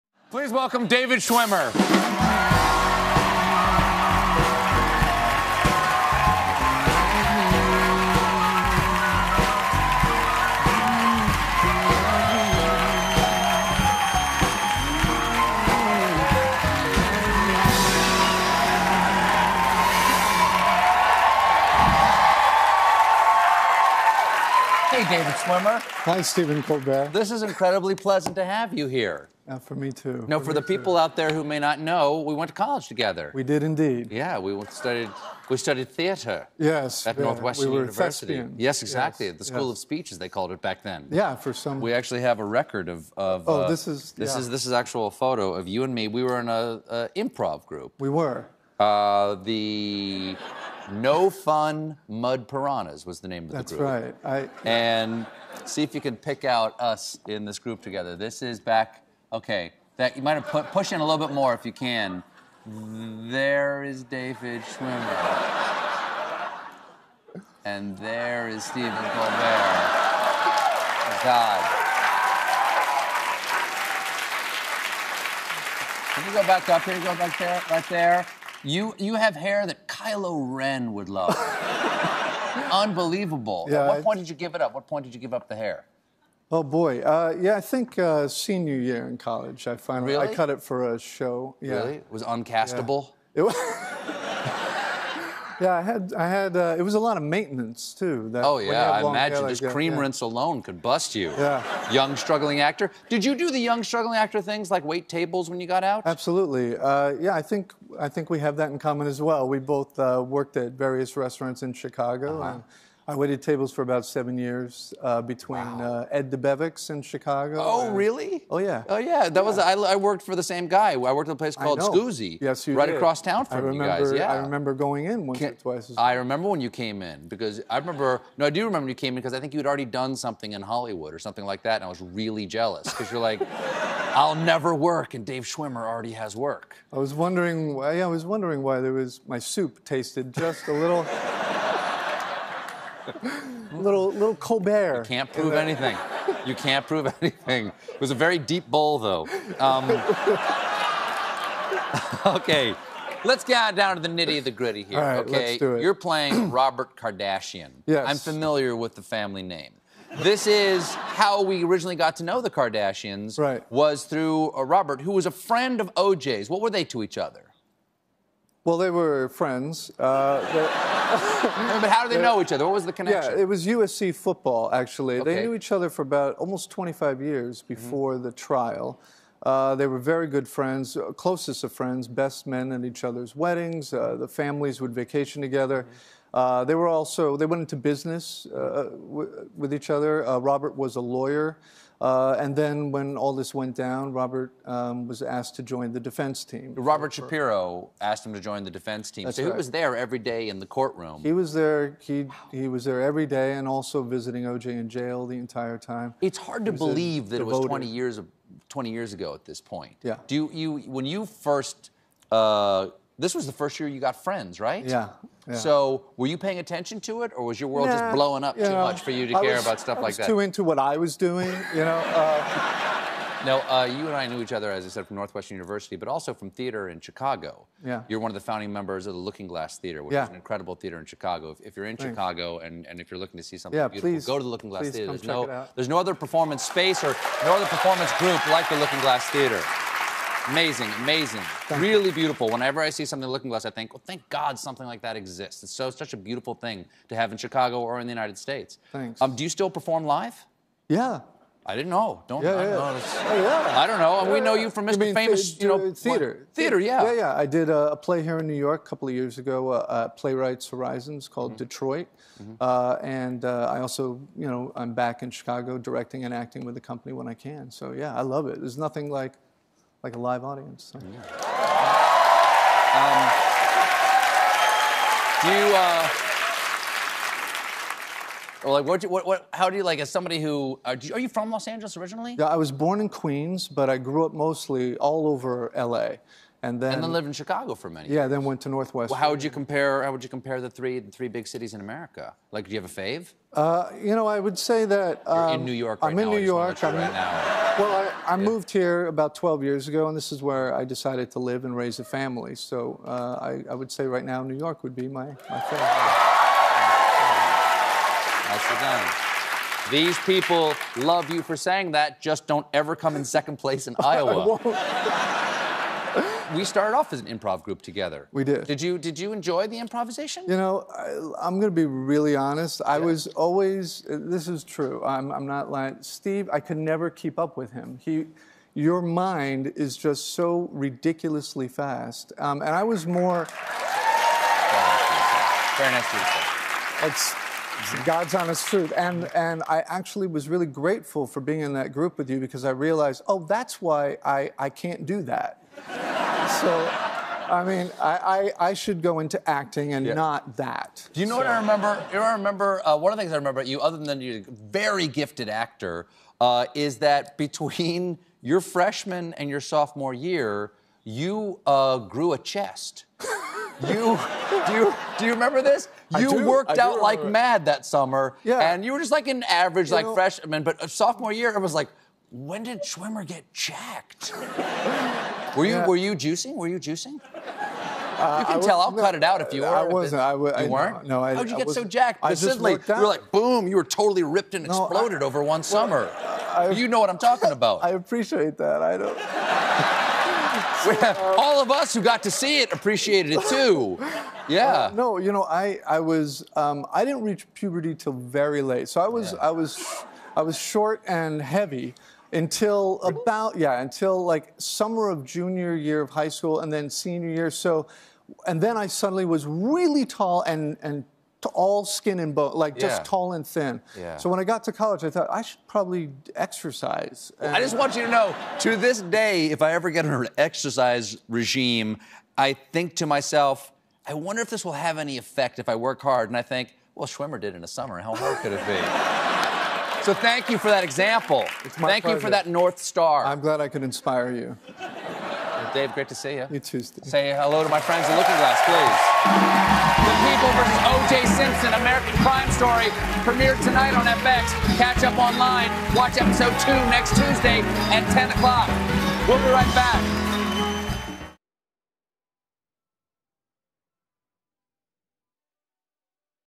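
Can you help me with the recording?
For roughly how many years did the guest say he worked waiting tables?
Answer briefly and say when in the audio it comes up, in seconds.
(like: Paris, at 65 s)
7, at 114 s.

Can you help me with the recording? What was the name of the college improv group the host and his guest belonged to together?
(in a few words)
No Fun Mud Piranhas.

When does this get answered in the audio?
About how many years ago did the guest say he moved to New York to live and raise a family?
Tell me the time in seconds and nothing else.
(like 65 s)
299 s.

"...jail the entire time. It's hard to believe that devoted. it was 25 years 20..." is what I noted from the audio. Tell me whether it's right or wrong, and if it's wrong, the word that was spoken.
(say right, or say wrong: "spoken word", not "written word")
wrong: "20", not "25".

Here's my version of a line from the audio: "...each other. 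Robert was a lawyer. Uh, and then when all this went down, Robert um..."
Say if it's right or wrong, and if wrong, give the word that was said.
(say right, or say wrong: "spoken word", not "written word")
right.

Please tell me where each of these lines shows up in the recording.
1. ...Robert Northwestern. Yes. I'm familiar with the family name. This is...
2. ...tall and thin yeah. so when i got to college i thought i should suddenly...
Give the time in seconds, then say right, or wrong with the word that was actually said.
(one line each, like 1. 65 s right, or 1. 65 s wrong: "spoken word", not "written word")
1. 156 s wrong: "Kardashian", not "Northwestern"
2. 413 s wrong: "probably", not "suddenly".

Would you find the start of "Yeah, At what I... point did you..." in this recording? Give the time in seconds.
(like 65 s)
83 s.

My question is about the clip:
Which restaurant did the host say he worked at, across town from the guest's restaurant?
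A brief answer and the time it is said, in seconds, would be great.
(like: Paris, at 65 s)
Scoozi, at 121 s.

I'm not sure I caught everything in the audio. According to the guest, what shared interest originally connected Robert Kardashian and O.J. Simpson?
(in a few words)
USC football.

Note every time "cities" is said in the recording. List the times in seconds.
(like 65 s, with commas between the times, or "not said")
291 s.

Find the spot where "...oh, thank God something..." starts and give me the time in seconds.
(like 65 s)
244 s.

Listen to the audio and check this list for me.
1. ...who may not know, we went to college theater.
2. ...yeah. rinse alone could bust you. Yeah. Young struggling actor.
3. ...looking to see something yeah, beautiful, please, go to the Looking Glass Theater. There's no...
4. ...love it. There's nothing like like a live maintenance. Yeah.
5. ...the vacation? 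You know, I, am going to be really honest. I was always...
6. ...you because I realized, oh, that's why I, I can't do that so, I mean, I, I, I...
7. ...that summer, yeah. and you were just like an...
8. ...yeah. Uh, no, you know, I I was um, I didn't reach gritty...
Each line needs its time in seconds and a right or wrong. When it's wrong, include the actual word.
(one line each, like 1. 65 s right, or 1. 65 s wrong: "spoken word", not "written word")
1. 31 s wrong: "together", not "theater"
2. 99 s right
3. 233 s right
4. 268 s wrong: "audience", not "maintenance"
5. 319 s wrong: "improvisation", not "vacation"
6. 342 s right
7. 367 s right
8. 394 s wrong: "puberty", not "gritty".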